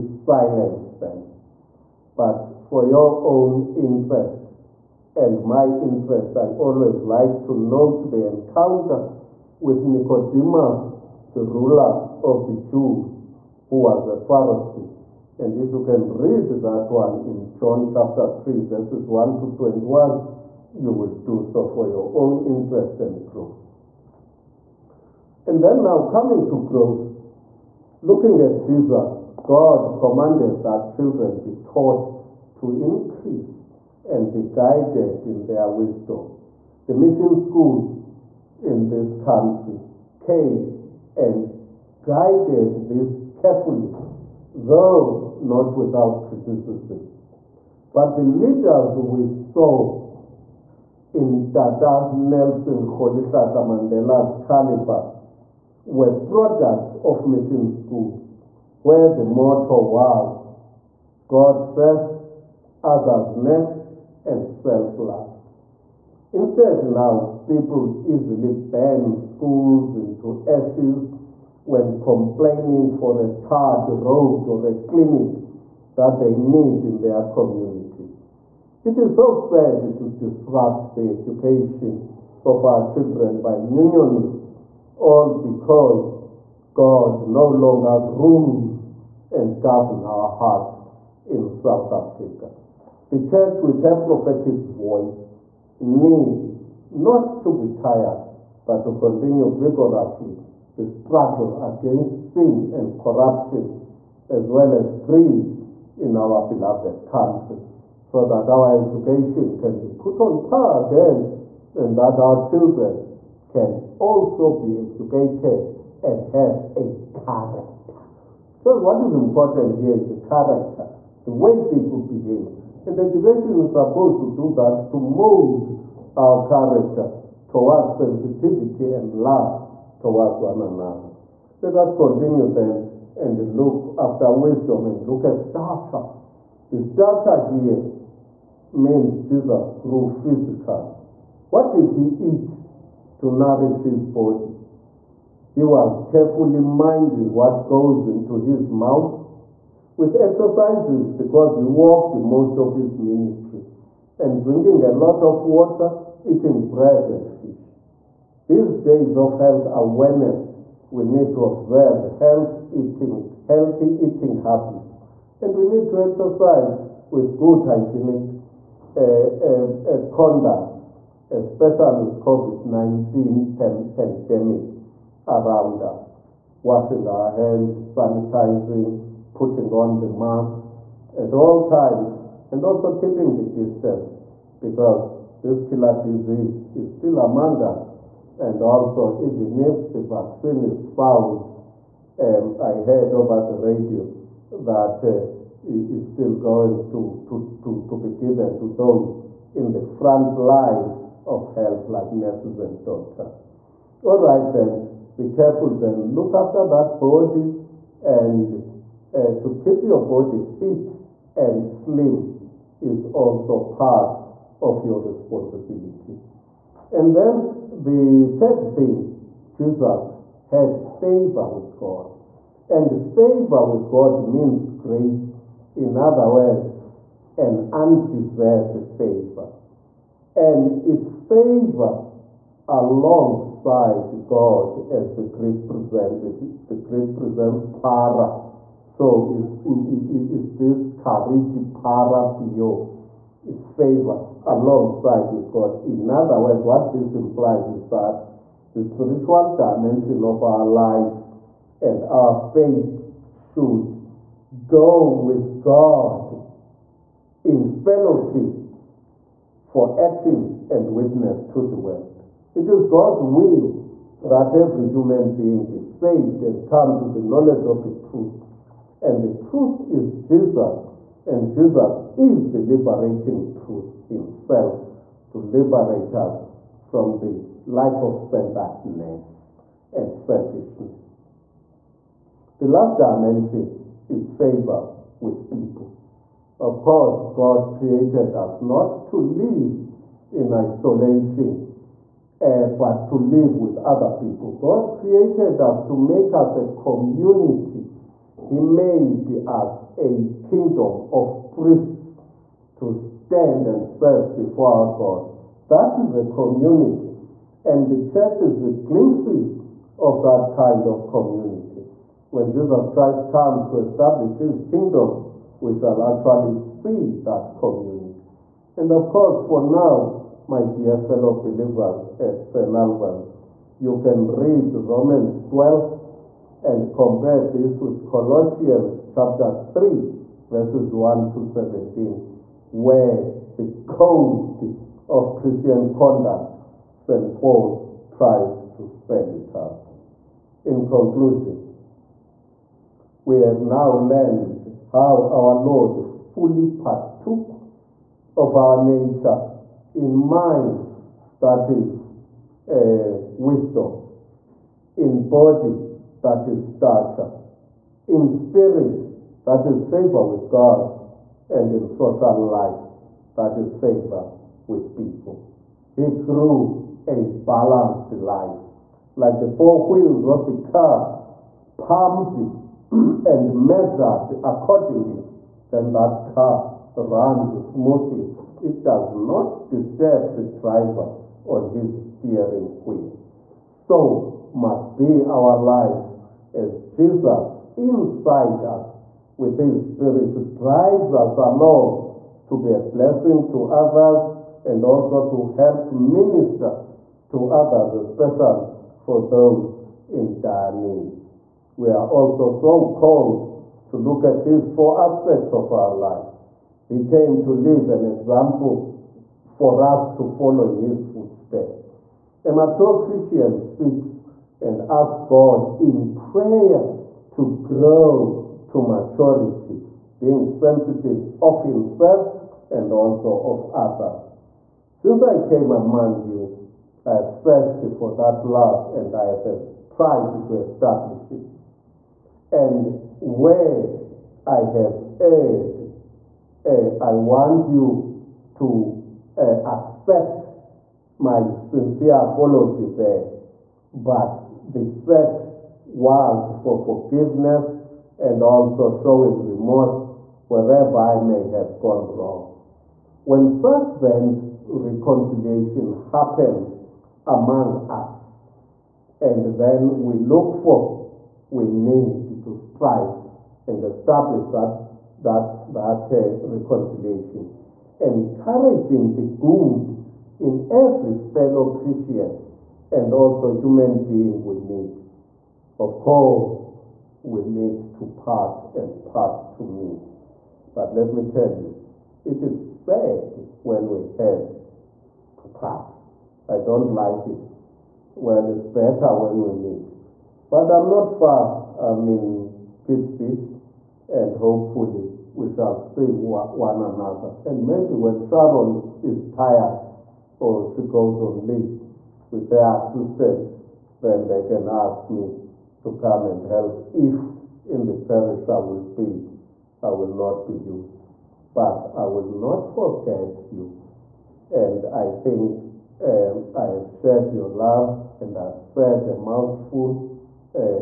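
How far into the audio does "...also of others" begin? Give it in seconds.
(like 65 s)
422 s.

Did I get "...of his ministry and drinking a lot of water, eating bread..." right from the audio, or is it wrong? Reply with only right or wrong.
right.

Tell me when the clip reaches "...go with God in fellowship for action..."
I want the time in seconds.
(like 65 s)
254 s.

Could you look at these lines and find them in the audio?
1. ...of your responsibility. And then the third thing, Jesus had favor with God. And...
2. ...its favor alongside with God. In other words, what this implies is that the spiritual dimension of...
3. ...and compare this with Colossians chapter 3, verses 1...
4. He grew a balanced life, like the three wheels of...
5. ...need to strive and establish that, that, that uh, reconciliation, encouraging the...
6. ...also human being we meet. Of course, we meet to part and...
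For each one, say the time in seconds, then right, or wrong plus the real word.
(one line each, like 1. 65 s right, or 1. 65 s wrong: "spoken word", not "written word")
1. 214 s right
2. 243 s right
3. 326 s right
4. 365 s wrong: "four", not "three"
5. 461 s right
6. 473 s right.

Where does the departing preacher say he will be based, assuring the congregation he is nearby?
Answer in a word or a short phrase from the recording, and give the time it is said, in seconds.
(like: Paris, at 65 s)
Pitts, at 492 s.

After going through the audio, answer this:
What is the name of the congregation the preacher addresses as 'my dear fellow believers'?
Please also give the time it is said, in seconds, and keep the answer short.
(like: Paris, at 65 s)
St. Albans, at 322 s.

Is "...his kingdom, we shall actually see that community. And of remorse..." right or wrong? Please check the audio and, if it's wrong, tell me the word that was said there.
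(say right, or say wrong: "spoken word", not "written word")
wrong: "course", not "remorse".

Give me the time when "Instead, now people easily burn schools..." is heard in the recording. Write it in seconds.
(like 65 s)
66 s.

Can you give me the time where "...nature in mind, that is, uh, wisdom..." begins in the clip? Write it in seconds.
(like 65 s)
348 s.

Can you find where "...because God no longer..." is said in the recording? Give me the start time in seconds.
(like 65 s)
85 s.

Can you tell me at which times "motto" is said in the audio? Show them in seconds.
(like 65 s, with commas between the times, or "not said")
59 s.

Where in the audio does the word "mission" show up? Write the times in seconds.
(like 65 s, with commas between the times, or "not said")
36 s, 57 s.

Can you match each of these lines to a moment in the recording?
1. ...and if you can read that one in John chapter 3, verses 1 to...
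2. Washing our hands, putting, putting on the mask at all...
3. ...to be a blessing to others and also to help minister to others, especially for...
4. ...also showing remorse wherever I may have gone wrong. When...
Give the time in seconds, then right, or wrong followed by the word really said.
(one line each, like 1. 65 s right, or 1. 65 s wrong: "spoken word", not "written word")
1. 15 s right
2. 176 s wrong: "sanitizing", not "putting"
3. 392 s right
4. 448 s right.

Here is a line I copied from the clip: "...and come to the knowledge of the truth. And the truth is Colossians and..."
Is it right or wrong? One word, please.
wrong.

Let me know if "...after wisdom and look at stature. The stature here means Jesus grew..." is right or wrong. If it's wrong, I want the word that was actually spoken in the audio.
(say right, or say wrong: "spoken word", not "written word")
right.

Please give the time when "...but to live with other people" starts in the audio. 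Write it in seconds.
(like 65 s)
292 s.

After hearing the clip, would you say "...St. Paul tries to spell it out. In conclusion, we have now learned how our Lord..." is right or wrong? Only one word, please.
right.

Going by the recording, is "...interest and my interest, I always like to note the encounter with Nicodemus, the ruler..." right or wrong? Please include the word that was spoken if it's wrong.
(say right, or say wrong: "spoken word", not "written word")
right.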